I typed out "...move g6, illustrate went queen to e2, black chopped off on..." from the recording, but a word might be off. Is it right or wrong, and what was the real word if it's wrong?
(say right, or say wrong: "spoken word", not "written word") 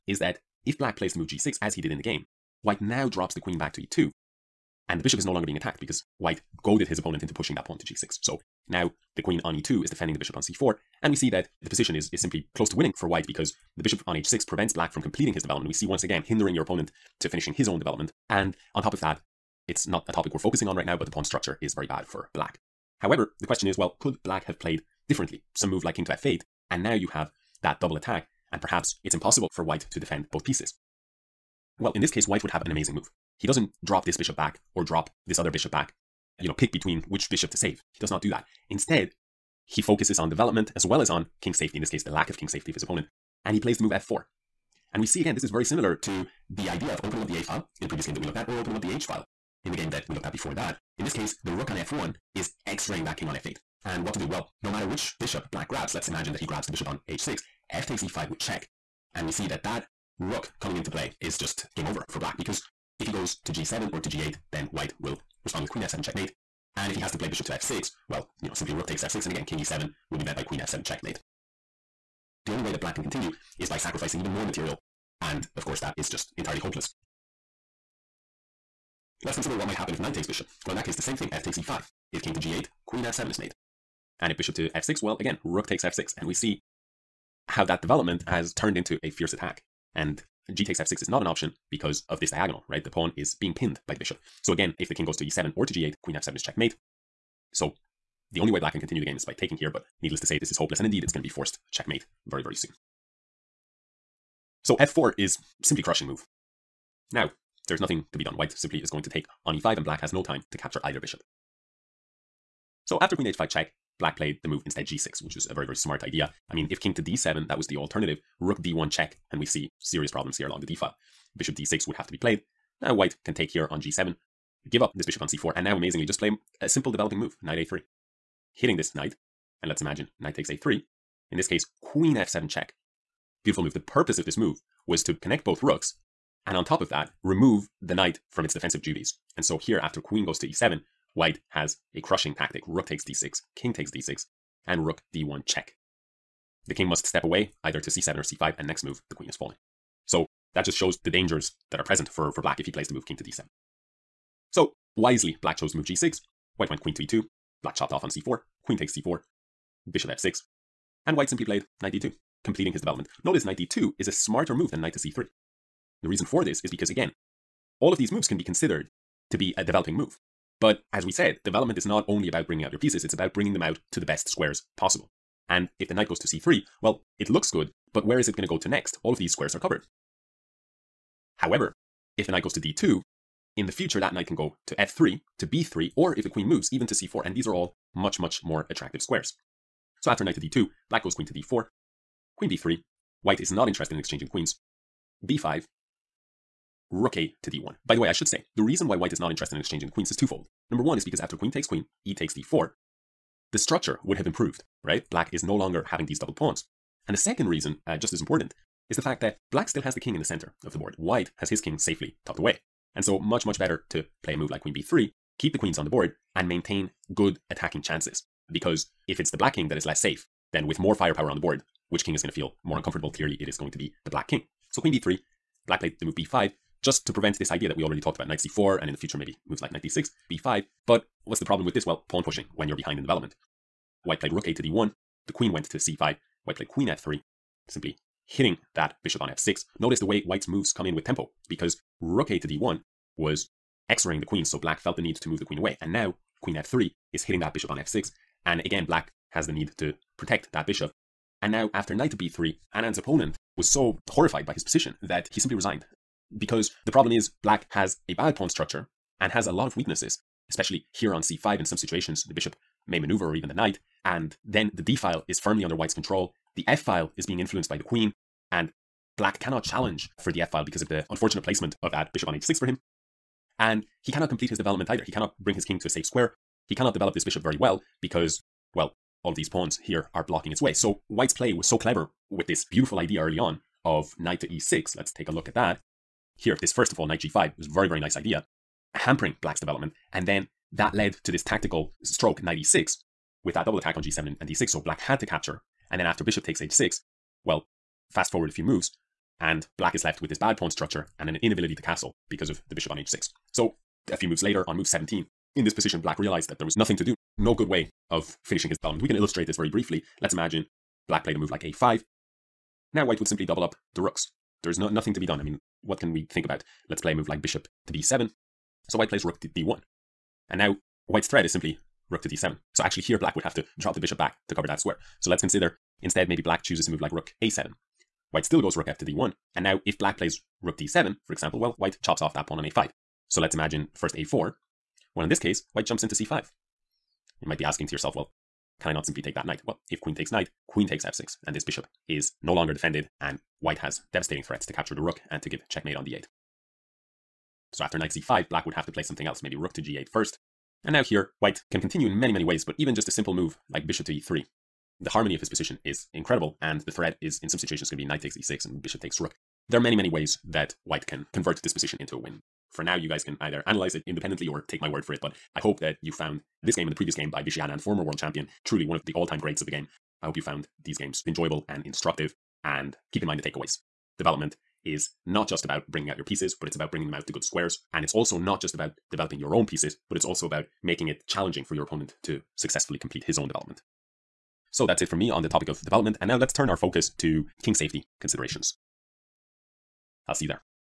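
wrong: "white", not "illustrate".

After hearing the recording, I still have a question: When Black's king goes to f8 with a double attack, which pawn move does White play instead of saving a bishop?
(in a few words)
f4.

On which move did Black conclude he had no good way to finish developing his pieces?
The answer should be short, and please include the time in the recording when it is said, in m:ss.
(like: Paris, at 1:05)
17, at 5:04.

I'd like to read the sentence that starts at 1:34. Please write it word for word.
So again, if the king goes to e7 or to g8, queen f7 is checkmate.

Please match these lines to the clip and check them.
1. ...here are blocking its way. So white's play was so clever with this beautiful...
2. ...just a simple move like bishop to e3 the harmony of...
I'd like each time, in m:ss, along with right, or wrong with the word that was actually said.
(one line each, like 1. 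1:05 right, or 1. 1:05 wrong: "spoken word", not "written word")
1. 4:39 right
2. 5:52 right.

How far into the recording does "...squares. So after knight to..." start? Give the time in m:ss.
3:09.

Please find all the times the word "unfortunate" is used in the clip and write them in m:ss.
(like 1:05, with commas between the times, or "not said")
4:31.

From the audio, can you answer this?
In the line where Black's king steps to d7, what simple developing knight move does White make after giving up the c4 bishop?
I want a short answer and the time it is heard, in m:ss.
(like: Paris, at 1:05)
knight a3, at 2:07.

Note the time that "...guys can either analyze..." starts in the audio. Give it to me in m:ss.
6:03.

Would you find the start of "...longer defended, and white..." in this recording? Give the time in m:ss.
5:42.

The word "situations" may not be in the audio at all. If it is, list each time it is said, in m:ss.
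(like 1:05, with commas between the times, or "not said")
4:21, 5:57.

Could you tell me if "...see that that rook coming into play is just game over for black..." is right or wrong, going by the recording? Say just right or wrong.
right.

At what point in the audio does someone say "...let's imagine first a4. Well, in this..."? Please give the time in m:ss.
5:33.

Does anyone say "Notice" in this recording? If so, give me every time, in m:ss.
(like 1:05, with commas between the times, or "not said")
2:43, 3:59.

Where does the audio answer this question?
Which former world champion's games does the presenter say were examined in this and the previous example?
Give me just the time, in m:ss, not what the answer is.
6:07.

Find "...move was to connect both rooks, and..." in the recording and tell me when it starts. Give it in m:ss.
2:14.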